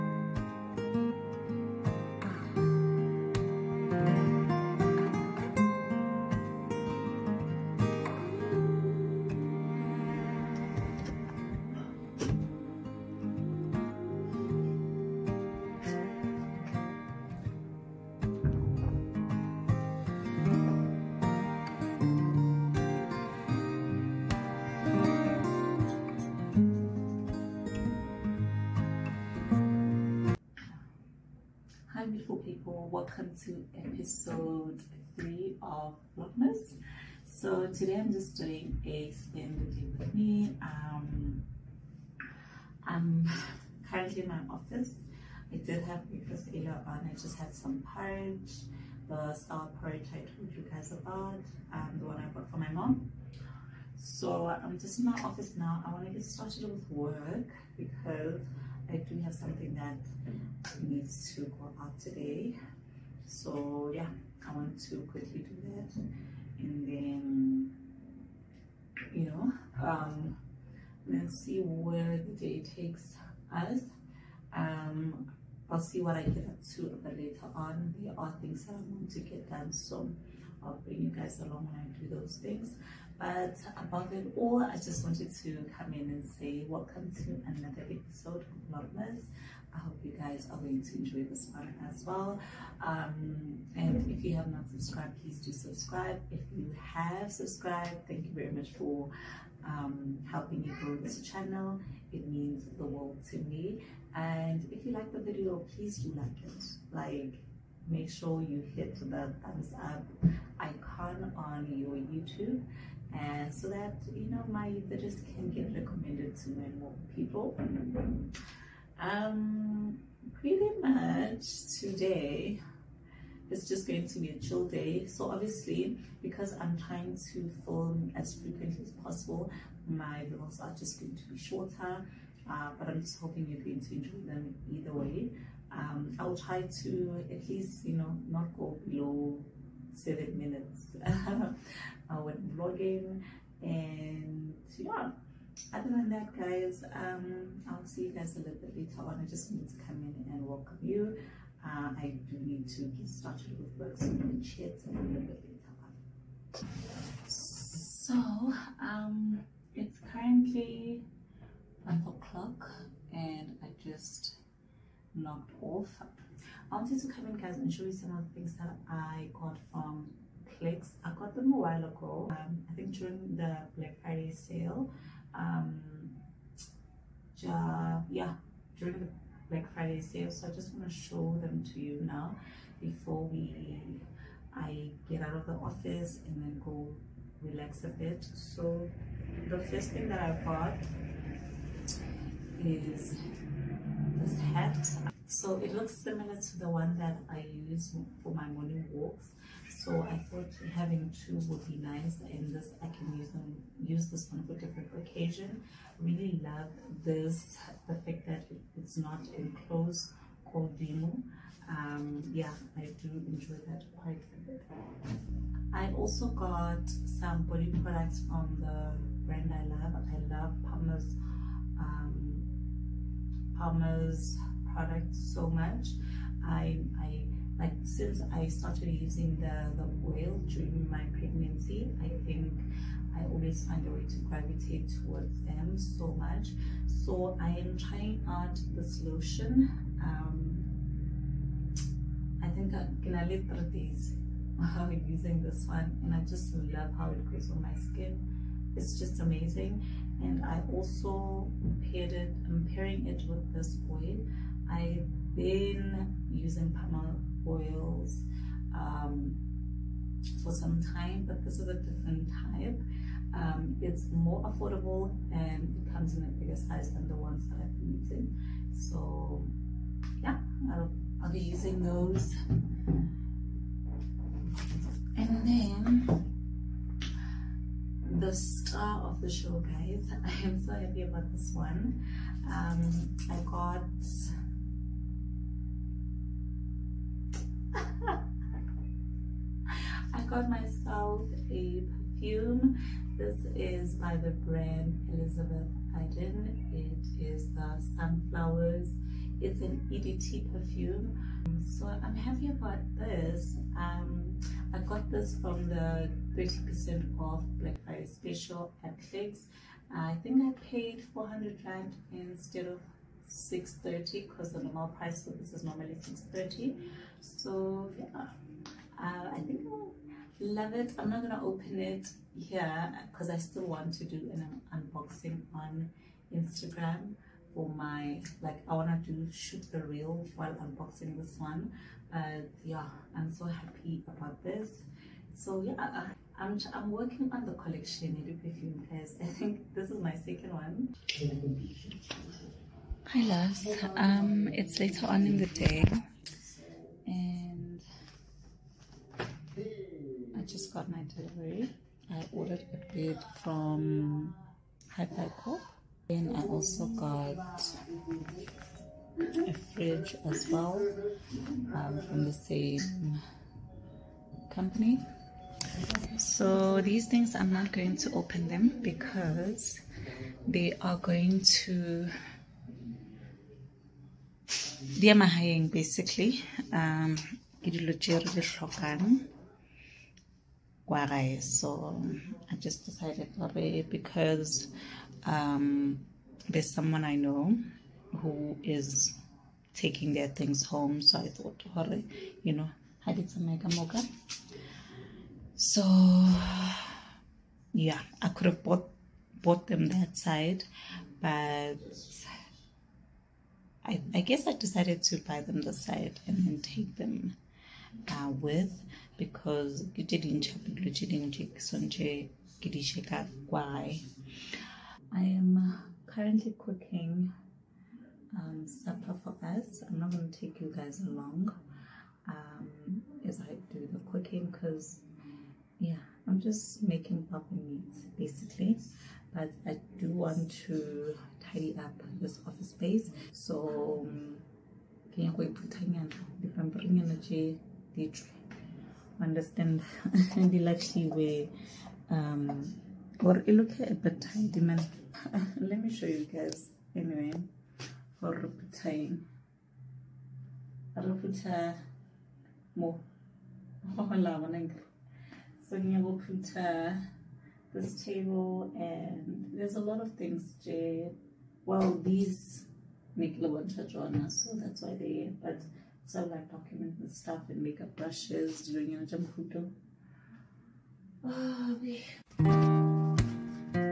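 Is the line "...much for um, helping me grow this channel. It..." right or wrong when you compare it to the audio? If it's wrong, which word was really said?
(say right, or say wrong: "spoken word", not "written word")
right.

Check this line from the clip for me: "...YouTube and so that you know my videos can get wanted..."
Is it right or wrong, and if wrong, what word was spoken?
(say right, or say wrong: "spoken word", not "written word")
wrong: "recommended", not "wanted".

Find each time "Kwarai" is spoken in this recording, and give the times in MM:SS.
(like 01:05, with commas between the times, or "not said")
06:23, 06:31.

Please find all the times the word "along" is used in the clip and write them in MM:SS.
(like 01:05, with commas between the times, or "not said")
01:21, 07:01.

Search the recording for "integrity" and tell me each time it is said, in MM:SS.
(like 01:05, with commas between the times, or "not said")
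not said.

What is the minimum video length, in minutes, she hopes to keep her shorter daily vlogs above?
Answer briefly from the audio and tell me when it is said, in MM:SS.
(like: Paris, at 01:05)
7, at 02:19.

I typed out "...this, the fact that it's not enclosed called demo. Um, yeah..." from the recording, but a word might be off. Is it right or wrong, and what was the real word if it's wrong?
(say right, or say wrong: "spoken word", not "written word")
right.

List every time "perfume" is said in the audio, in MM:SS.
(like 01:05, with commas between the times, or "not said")
04:51, 05:00, 05:38.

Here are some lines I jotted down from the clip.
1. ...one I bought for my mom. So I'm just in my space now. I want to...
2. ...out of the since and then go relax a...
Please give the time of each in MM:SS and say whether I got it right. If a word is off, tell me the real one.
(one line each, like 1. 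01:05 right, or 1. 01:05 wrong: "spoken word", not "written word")
1. 00:52 wrong: "office", not "space"
2. 03:05 wrong: "office", not "since".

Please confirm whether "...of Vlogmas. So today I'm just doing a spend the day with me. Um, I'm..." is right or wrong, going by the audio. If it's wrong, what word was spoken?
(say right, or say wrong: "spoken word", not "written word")
right.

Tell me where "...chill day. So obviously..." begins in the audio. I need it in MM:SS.
02:04.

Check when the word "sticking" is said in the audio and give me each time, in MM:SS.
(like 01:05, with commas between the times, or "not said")
not said.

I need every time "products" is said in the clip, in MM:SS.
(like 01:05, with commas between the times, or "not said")
03:37, 03:44.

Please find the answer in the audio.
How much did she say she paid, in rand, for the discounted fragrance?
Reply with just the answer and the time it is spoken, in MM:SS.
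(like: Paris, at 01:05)
400 Rand, at 05:11.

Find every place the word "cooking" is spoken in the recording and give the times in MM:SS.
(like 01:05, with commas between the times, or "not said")
06:56, 07:04.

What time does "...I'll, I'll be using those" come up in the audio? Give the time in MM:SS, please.
04:30.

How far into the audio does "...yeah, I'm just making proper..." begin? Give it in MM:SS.
07:05.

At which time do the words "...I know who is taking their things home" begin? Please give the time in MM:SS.
06:27.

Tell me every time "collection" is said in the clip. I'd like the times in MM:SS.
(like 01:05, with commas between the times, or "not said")
05:37.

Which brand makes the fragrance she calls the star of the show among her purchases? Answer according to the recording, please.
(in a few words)
Elizabeth Arden.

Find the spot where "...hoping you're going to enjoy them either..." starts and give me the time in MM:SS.
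02:13.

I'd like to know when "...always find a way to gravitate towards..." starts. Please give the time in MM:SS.
03:53.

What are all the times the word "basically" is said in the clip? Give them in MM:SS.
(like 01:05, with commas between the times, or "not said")
06:15, 07:08.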